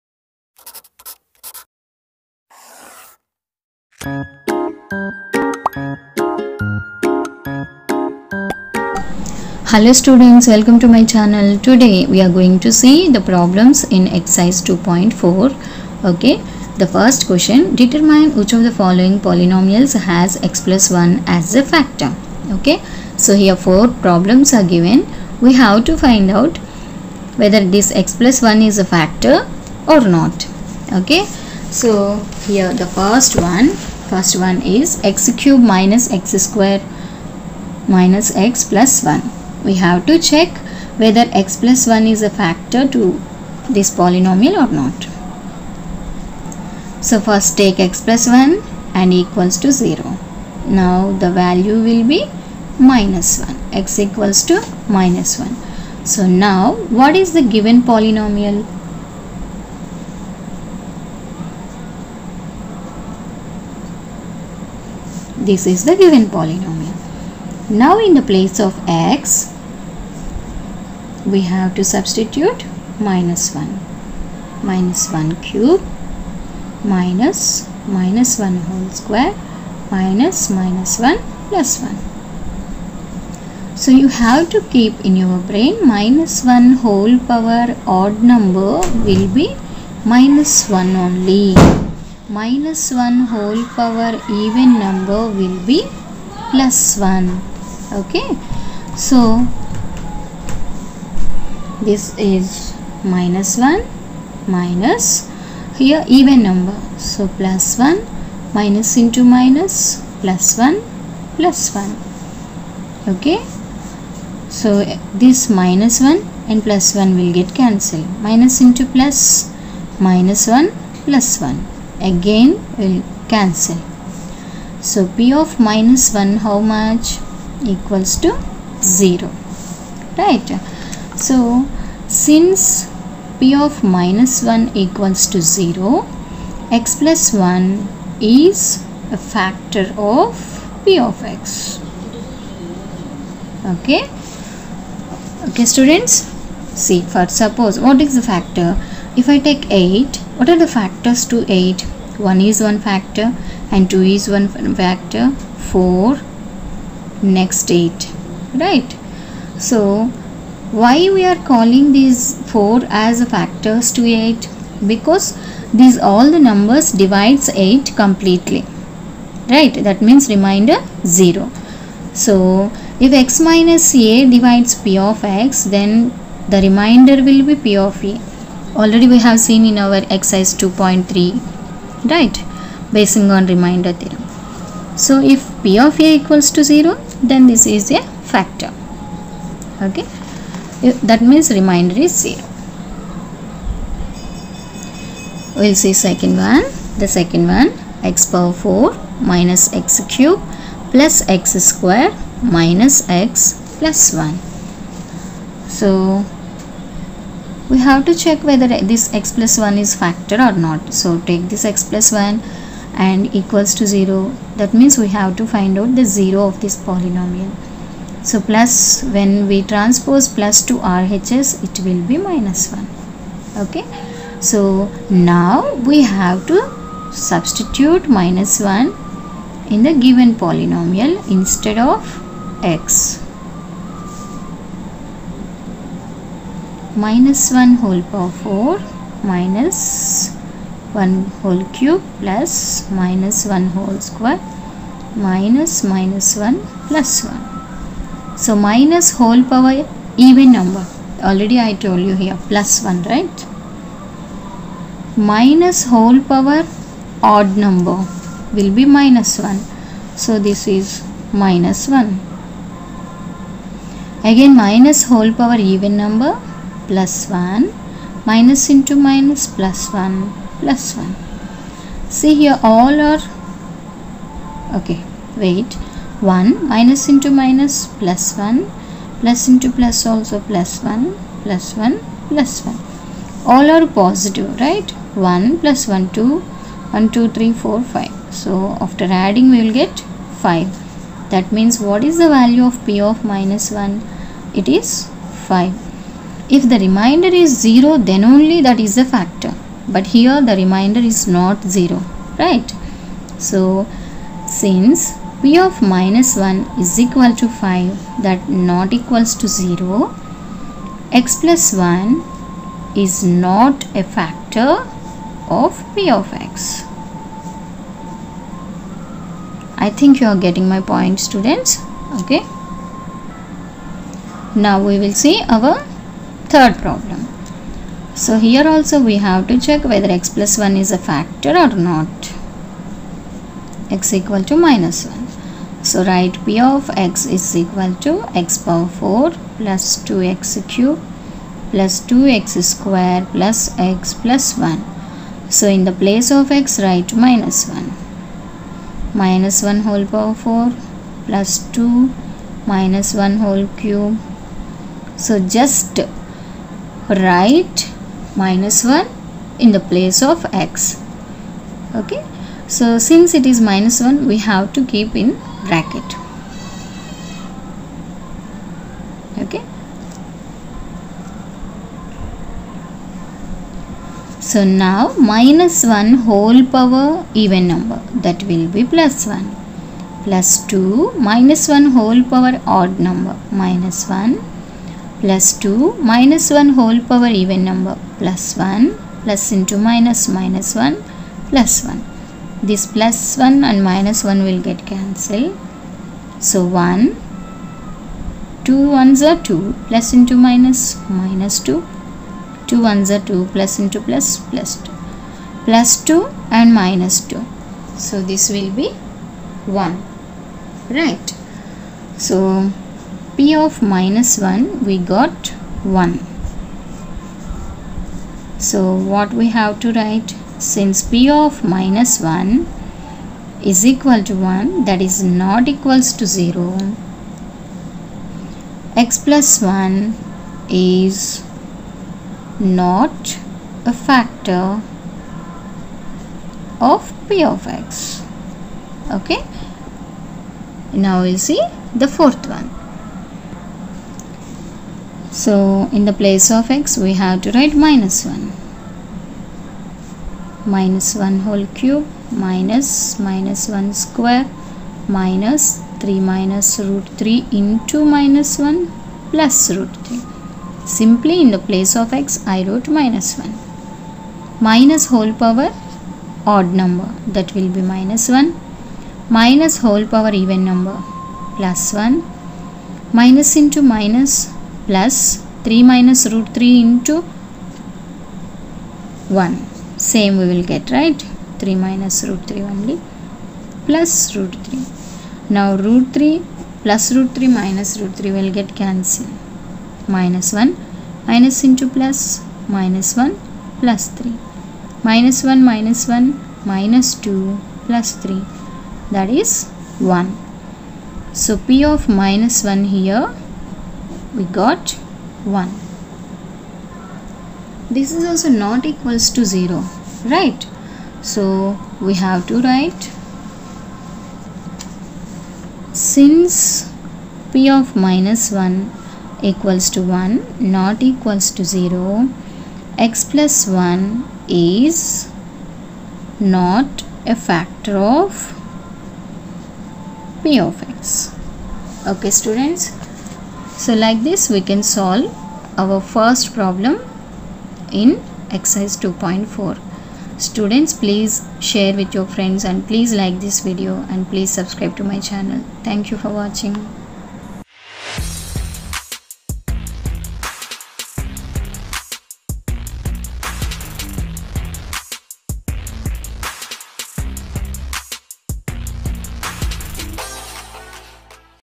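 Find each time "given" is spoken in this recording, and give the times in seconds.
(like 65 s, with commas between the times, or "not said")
24 s, 57 s, 65 s, 230 s.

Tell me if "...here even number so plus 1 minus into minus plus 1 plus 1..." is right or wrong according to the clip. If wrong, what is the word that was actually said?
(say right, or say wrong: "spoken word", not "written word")
right.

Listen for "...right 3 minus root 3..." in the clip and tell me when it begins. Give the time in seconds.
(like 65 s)
480 s.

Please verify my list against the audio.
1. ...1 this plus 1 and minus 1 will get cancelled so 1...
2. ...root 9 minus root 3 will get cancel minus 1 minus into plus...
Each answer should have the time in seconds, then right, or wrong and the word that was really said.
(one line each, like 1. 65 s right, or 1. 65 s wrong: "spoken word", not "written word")
1. 391 s right
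2. 487 s wrong: "3", not "9".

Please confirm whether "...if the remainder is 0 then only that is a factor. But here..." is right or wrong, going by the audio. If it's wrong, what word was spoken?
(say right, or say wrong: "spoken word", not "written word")
right.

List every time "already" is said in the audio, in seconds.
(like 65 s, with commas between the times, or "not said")
178 s, 251 s.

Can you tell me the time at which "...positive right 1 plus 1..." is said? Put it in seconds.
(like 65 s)
284 s.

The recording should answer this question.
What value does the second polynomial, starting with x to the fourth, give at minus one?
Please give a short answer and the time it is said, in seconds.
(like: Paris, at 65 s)
5, at 289 s.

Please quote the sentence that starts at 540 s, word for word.
Students please share with your friends and please like this video and please subscribe to my channel.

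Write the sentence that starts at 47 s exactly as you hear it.
So first take x plus 1 and equals to 0.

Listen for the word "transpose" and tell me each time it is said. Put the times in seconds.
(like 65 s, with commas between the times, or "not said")
219 s.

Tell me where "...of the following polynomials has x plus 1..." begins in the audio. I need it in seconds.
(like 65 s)
18 s.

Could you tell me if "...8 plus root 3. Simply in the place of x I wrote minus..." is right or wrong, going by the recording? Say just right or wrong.
wrong.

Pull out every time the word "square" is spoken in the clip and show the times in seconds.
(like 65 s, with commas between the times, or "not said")
36 s, 79 s, 201 s, 244 s, 342 s, 454 s.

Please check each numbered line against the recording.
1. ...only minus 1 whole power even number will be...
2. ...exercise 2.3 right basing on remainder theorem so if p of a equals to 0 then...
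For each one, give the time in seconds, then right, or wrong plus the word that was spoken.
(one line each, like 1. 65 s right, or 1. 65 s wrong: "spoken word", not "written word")
1. 90 s right
2. 180 s right.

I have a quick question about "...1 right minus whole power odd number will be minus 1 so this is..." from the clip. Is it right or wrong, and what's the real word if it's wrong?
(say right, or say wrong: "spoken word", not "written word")
right.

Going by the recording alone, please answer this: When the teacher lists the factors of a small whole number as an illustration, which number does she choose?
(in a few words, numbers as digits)
8.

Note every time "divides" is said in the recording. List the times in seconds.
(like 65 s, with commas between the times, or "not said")
167 s, 174 s.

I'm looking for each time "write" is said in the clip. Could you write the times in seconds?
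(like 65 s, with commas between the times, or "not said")
336 s, 346 s, 357 s, 419 s, 447 s, 512 s.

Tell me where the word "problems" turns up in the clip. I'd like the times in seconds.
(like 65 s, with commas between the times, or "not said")
13 s, 23 s, 326 s, 536 s.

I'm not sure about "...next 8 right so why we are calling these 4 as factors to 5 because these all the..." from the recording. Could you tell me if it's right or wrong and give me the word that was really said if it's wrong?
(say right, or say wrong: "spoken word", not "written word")
wrong: "8", not "5".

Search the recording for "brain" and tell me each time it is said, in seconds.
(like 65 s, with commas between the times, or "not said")
85 s.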